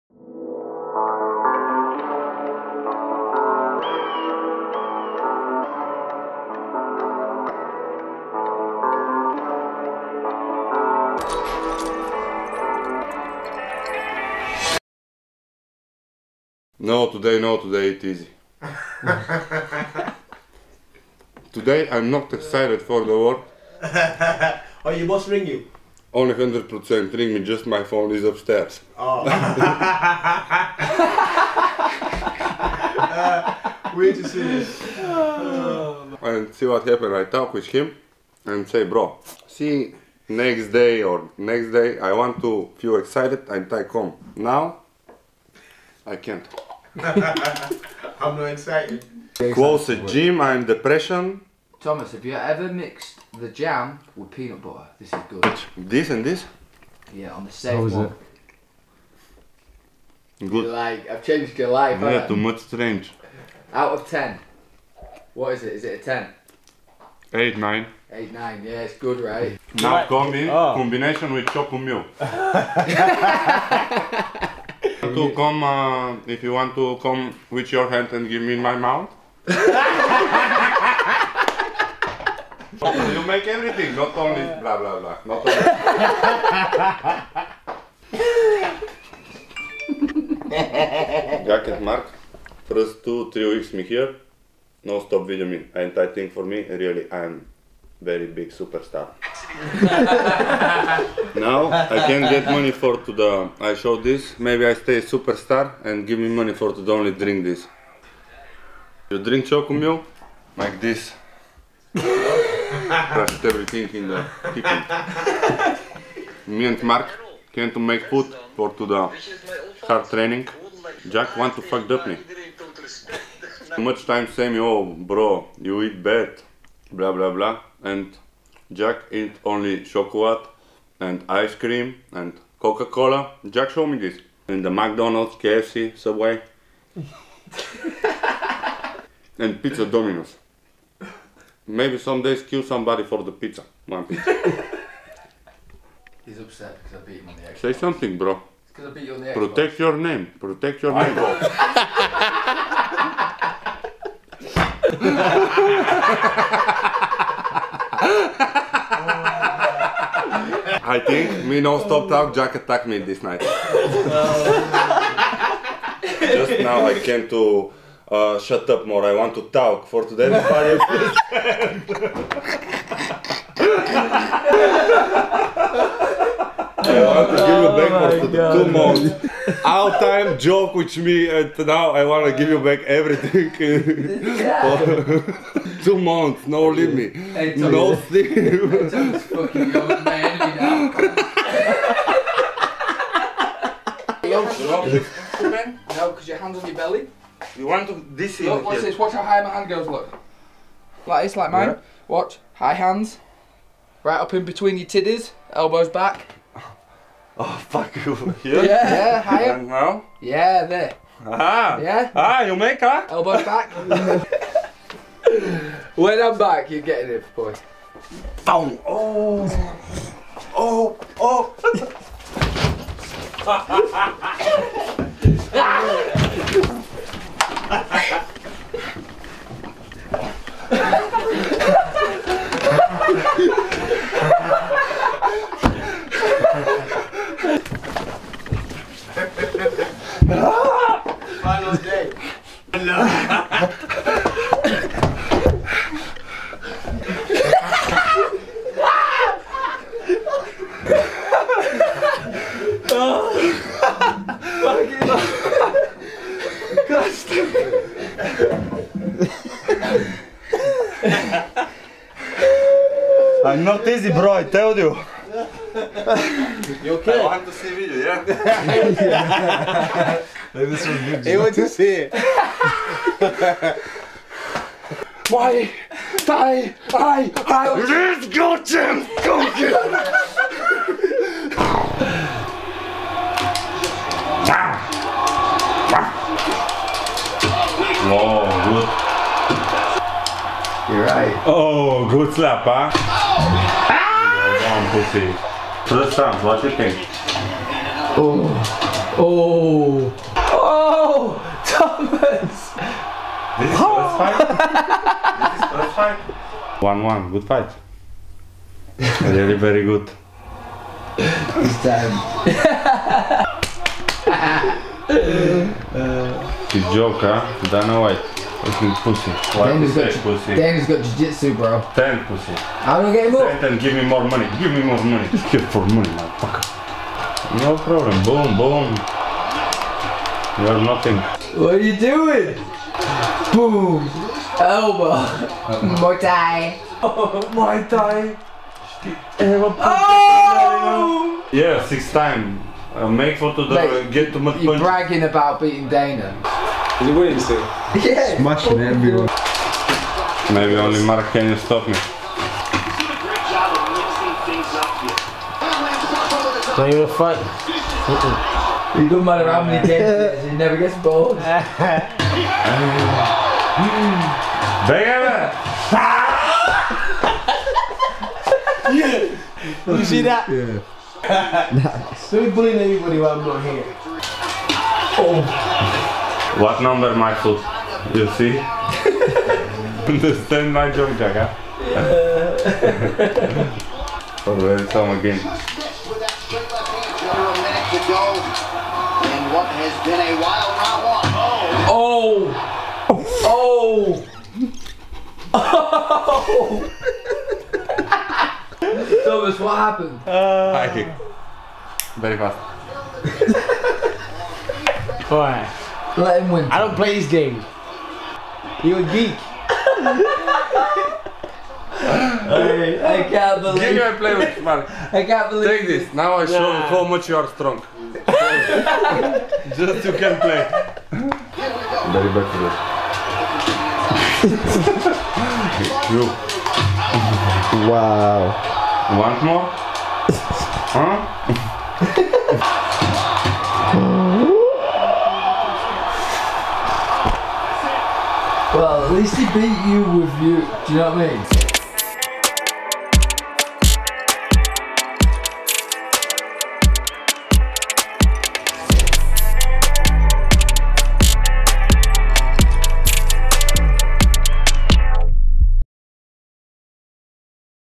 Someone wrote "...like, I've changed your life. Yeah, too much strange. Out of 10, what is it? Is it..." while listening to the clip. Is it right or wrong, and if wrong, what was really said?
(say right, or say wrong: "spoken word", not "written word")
right.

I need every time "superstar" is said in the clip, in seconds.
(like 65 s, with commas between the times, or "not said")
98 s, 105 s.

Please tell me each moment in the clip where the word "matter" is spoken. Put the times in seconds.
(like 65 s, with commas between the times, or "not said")
359 s.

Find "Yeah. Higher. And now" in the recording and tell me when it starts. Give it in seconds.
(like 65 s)
208 s.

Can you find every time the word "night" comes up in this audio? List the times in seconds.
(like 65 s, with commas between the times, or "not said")
163 s.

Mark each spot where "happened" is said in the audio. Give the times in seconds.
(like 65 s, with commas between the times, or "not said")
36 s, 399 s.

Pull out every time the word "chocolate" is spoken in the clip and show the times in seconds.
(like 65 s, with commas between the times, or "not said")
71 s, 129 s.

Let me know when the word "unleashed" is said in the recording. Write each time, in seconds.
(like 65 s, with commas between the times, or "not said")
not said.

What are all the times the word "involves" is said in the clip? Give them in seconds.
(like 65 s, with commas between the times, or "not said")
not said.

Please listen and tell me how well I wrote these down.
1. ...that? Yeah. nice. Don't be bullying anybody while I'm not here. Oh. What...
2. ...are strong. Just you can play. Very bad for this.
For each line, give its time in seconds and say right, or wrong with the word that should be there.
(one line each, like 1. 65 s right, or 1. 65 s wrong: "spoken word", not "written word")
1. 370 s right
2. 417 s right.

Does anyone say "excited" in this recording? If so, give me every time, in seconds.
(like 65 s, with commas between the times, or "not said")
22 s, 42 s, 48 s.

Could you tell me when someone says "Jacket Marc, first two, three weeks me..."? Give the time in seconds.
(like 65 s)
91 s.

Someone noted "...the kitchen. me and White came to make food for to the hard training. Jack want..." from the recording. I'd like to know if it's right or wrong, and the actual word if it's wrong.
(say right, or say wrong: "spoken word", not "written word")
wrong: "Marc", not "White".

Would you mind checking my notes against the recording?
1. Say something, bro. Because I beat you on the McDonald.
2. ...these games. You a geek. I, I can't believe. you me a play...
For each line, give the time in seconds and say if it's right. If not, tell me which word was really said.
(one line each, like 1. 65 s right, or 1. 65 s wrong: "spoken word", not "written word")
1. 147 s wrong: "Xbox", not "McDonald"
2. 407 s right.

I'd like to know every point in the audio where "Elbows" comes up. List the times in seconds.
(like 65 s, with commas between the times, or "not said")
205 s, 213 s, 334 s.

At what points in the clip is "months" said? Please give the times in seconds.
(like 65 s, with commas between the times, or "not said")
178 s, 185 s.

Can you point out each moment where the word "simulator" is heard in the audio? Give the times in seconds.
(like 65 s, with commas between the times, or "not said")
not said.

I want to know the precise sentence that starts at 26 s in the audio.
Only 100% ring me, just my phone is upstairs.